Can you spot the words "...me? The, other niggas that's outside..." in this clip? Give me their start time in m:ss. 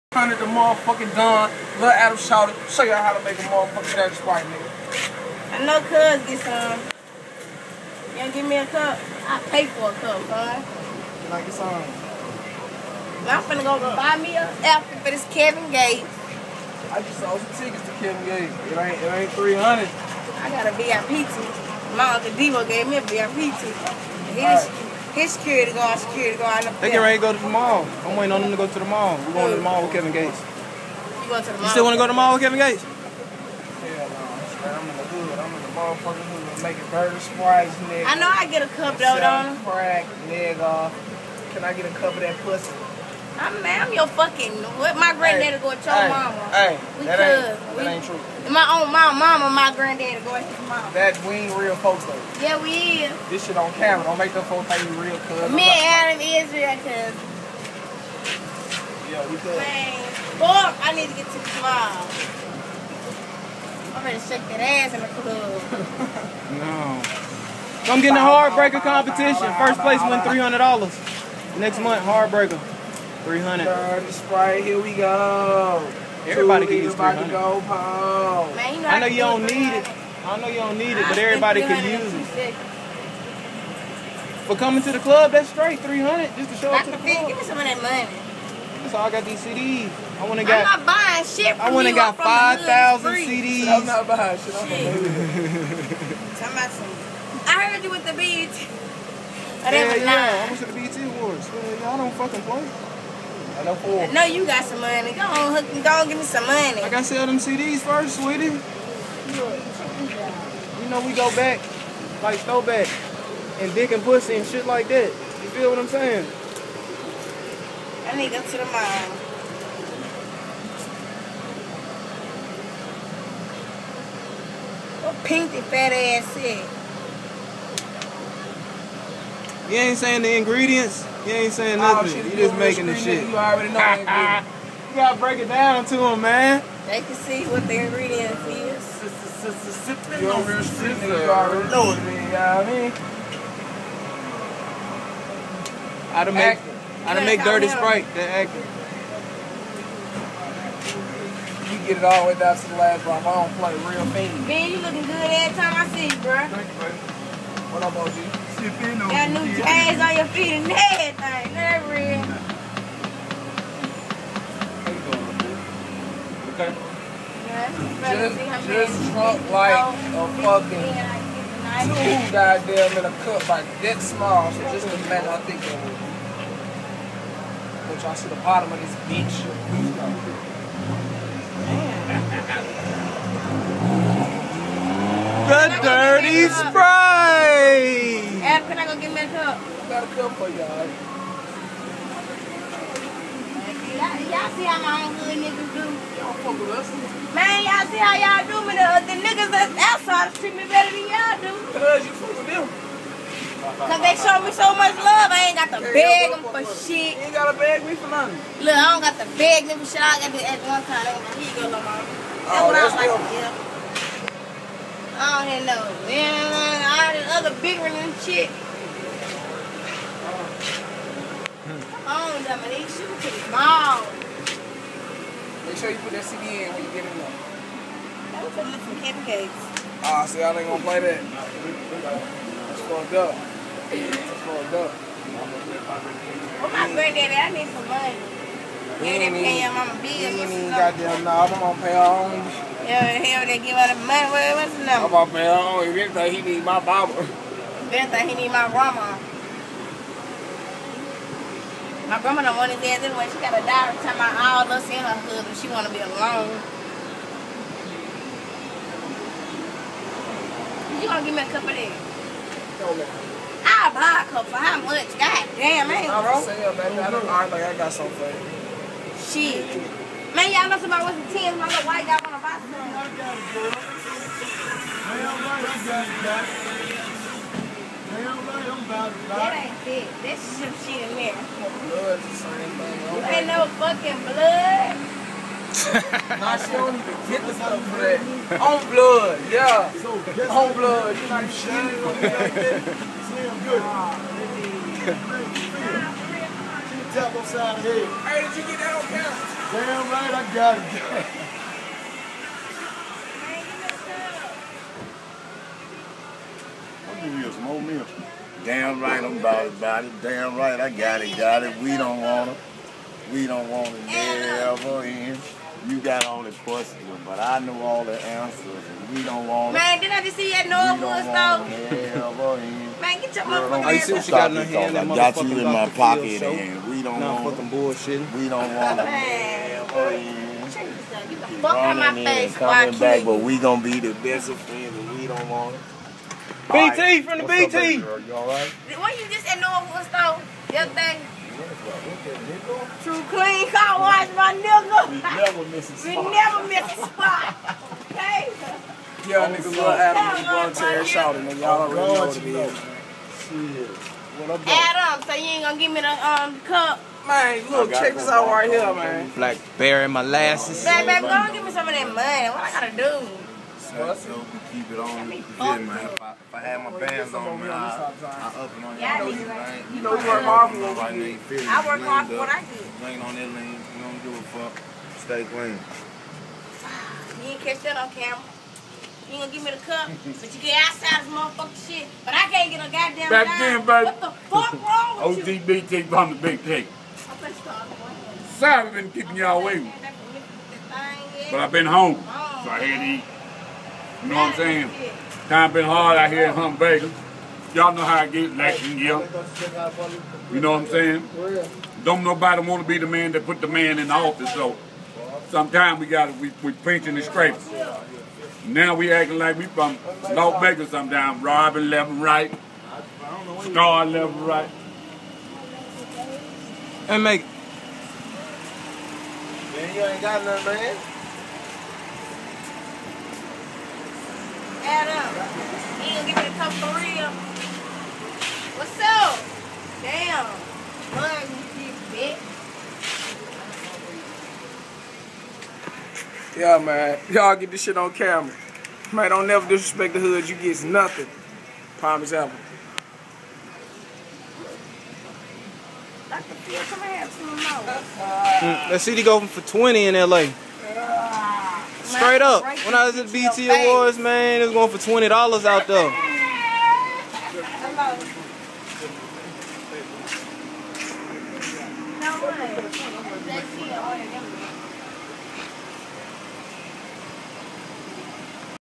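3:18.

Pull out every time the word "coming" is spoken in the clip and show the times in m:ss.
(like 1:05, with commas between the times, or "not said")
1:24, 5:32.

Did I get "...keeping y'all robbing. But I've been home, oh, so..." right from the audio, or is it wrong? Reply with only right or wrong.
wrong.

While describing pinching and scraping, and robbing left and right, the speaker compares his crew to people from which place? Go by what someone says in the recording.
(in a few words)
North Vegas.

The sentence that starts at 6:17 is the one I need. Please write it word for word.
You didn't catch that on camera.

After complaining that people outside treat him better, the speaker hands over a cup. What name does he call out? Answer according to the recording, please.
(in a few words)
Lamar.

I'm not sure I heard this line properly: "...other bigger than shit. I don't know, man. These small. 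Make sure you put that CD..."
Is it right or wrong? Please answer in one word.
right.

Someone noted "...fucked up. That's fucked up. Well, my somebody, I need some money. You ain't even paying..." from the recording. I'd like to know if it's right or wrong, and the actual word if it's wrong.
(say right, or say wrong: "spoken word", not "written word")
wrong: "granddaddy", not "somebody".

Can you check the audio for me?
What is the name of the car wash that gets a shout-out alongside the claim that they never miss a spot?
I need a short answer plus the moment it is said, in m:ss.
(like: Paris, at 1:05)
True Clean Car Wash, at 5:43.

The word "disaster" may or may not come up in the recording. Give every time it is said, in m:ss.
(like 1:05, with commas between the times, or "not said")
not said.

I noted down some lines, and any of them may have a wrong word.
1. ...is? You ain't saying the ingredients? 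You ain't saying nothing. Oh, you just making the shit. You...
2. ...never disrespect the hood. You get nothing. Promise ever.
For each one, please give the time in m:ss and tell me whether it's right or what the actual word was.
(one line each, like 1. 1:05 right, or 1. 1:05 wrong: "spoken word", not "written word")
1. 2:06 right
2. 7:19 right.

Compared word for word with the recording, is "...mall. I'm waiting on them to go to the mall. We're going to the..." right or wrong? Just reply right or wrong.
right.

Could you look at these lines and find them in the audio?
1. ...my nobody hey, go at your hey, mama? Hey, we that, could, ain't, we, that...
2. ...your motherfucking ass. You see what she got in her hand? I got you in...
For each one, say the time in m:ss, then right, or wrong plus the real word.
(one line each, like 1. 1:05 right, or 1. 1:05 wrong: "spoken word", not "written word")
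1. 0:44 wrong: "granddaddy", not "nobody"
2. 5:23 right.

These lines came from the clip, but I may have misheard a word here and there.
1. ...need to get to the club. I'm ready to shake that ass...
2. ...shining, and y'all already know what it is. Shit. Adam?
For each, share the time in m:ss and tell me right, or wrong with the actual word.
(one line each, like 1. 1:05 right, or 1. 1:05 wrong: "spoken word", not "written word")
1. 1:00 right
2. 5:51 wrong: "shouting", not "shining".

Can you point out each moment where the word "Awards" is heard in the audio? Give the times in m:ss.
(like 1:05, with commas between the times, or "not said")
1:41, 7:33.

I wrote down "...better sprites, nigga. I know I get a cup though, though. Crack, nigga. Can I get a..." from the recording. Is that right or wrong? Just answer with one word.
wrong.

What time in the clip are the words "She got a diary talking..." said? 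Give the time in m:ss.
4:13.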